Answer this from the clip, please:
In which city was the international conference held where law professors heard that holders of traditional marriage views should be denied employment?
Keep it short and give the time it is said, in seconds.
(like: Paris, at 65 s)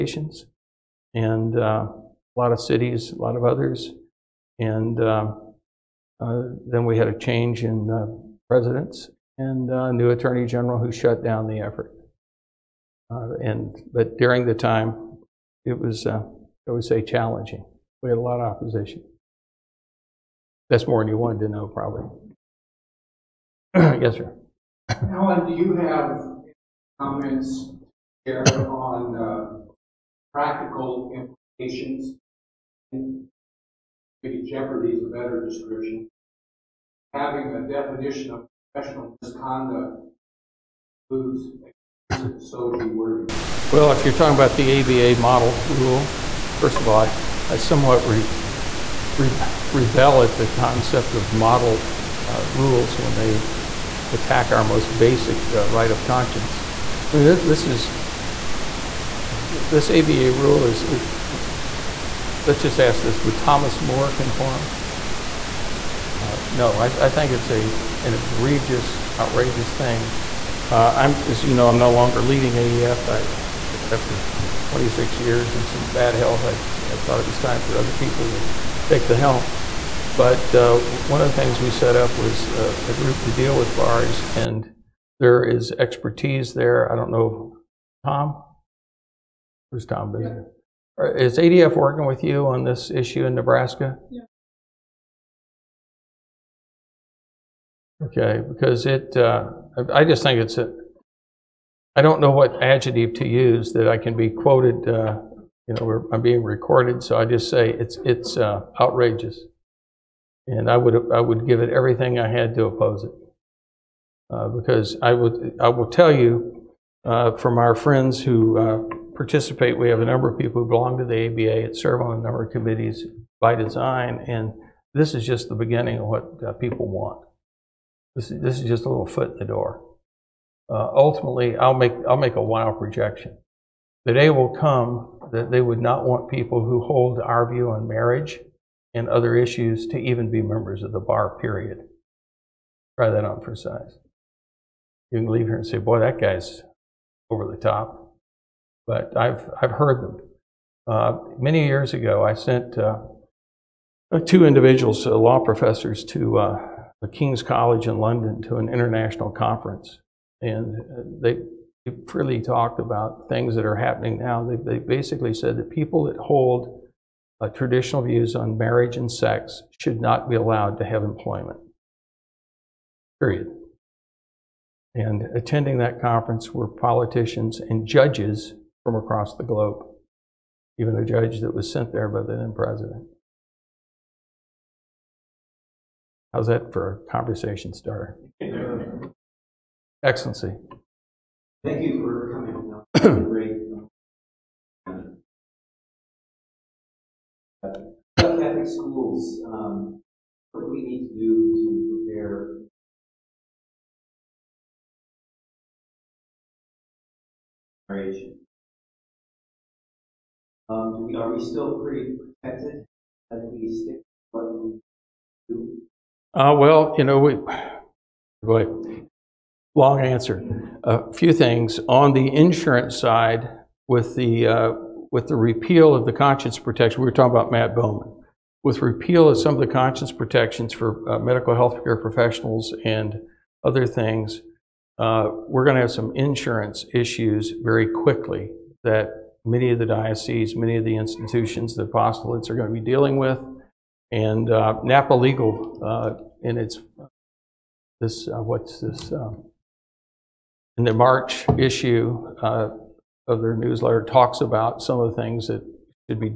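London, at 157 s.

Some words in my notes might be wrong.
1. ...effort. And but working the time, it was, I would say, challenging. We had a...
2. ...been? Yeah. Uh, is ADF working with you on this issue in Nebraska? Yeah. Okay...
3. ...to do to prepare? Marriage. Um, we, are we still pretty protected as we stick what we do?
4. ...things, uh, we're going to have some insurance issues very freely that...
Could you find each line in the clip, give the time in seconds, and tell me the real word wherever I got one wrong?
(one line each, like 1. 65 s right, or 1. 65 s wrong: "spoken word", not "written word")
1. 11 s wrong: "during", not "working"
2. 90 s right
3. 201 s right
4. 233 s wrong: "quickly", not "freely".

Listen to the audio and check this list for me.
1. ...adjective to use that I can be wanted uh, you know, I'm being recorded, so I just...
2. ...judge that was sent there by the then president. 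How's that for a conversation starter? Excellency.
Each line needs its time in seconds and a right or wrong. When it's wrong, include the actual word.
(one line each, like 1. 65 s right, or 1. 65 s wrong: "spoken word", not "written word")
1. 102 s wrong: "quoted", not "wanted"
2. 181 s right.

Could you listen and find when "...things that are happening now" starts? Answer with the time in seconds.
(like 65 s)
163 s.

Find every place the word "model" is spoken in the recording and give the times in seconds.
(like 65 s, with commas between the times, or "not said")
45 s, 51 s.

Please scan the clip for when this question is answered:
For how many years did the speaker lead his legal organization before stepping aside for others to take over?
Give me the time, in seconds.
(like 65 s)
74 s.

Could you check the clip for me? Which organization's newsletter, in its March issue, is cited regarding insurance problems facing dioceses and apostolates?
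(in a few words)
Napa Legal.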